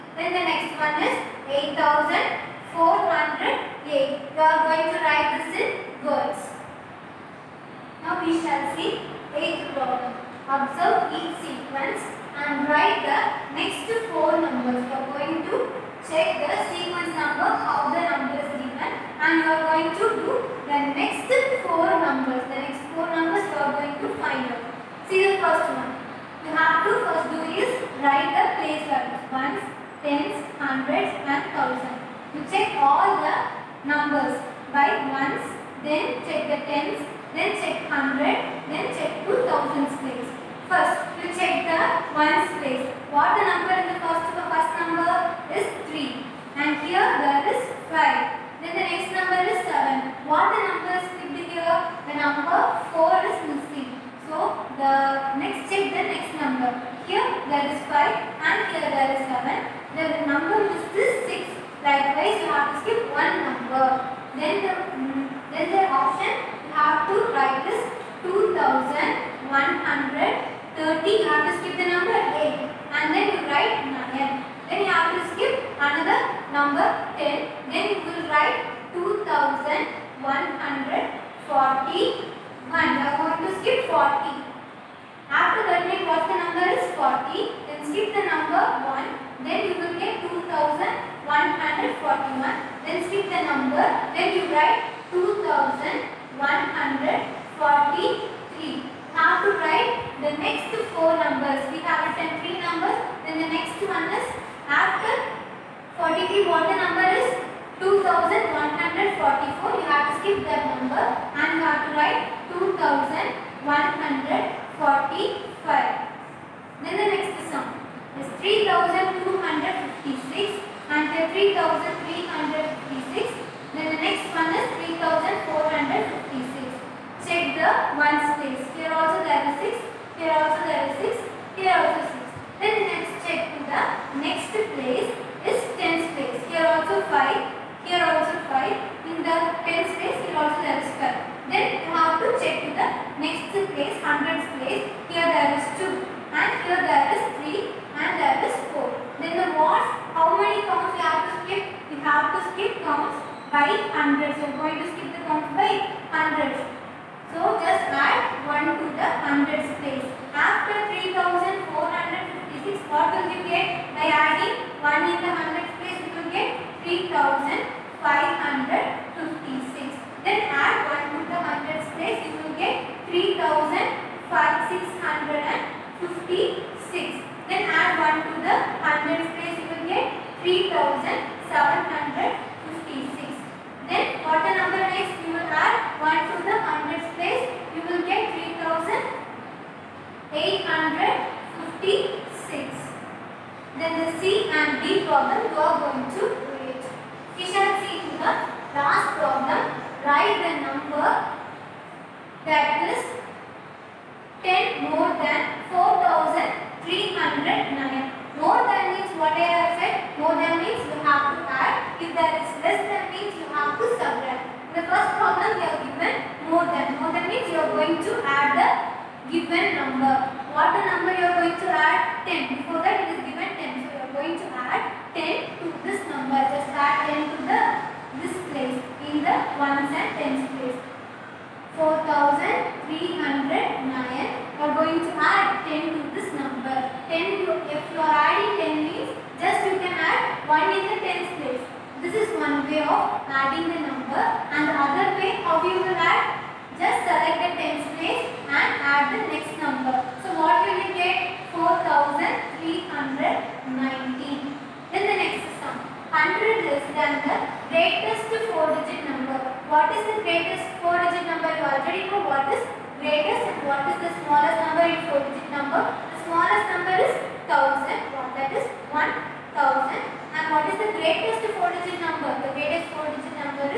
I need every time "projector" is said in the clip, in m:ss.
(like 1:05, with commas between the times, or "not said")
not said.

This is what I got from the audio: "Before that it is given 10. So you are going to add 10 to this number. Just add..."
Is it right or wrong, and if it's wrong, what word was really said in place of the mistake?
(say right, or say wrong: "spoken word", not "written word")
right.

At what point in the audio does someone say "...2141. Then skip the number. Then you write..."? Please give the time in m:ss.
1:30.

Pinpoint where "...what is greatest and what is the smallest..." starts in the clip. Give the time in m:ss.
4:22.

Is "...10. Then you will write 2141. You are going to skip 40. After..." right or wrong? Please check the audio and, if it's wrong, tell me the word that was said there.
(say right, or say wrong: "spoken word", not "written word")
right.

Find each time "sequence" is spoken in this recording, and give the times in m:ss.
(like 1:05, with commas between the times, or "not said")
0:11, 0:16.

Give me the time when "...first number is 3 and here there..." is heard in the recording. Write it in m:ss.
0:44.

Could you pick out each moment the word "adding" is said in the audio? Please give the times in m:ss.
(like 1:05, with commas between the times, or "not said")
3:58, 4:03.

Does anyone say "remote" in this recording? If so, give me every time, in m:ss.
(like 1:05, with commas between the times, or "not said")
not said.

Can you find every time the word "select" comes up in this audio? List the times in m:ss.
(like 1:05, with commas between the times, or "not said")
4:07.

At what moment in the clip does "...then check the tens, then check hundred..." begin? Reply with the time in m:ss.
0:35.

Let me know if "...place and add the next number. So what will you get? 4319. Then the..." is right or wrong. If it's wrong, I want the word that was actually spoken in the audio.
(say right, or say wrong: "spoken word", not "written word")
right.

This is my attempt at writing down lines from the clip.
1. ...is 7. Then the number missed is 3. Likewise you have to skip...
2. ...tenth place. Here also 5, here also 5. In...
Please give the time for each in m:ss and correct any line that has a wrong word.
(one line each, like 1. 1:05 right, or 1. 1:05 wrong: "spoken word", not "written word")
1. 0:59 wrong: "6", not "3"
2. 2:15 right.